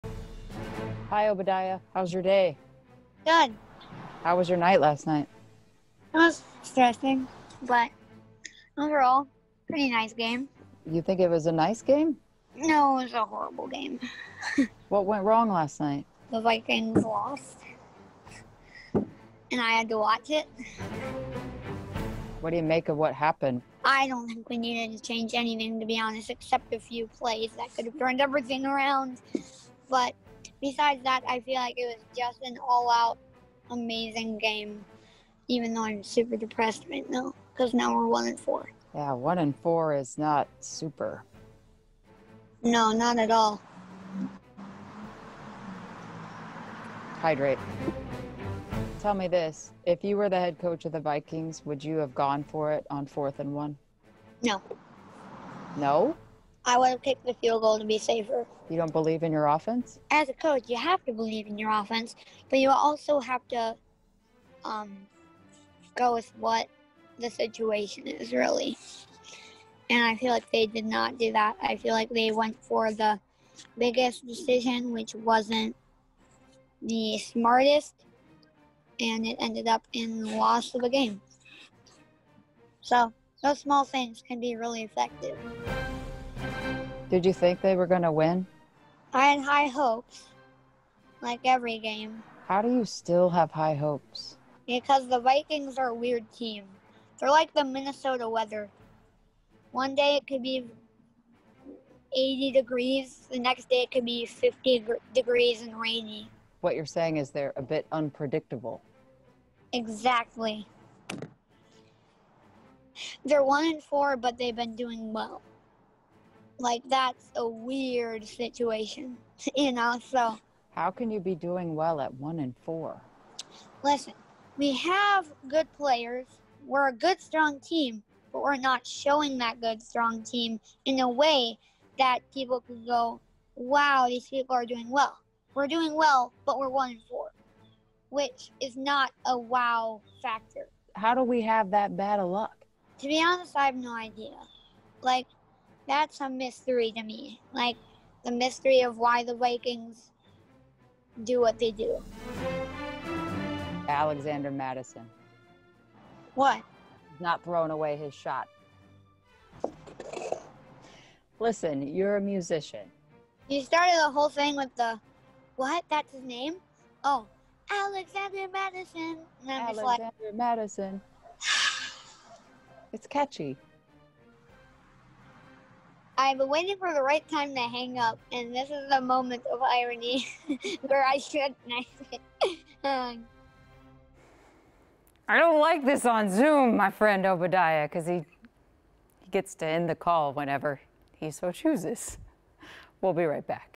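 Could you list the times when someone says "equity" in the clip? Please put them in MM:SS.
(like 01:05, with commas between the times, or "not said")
not said.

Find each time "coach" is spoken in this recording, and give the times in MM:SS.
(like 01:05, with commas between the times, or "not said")
00:50, 01:00.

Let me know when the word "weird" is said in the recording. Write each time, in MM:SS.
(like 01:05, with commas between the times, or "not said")
01:35, 01:57.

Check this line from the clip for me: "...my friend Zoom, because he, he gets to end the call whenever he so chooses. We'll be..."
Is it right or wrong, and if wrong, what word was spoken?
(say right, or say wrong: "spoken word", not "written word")
wrong: "Obadiah", not "Zoom".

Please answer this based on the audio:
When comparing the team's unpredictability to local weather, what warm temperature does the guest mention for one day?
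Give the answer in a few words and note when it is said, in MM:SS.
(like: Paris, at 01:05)
80 degrees, at 01:42.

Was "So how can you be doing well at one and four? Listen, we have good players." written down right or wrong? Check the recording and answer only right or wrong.
right.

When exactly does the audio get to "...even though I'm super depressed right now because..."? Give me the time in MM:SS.
00:35.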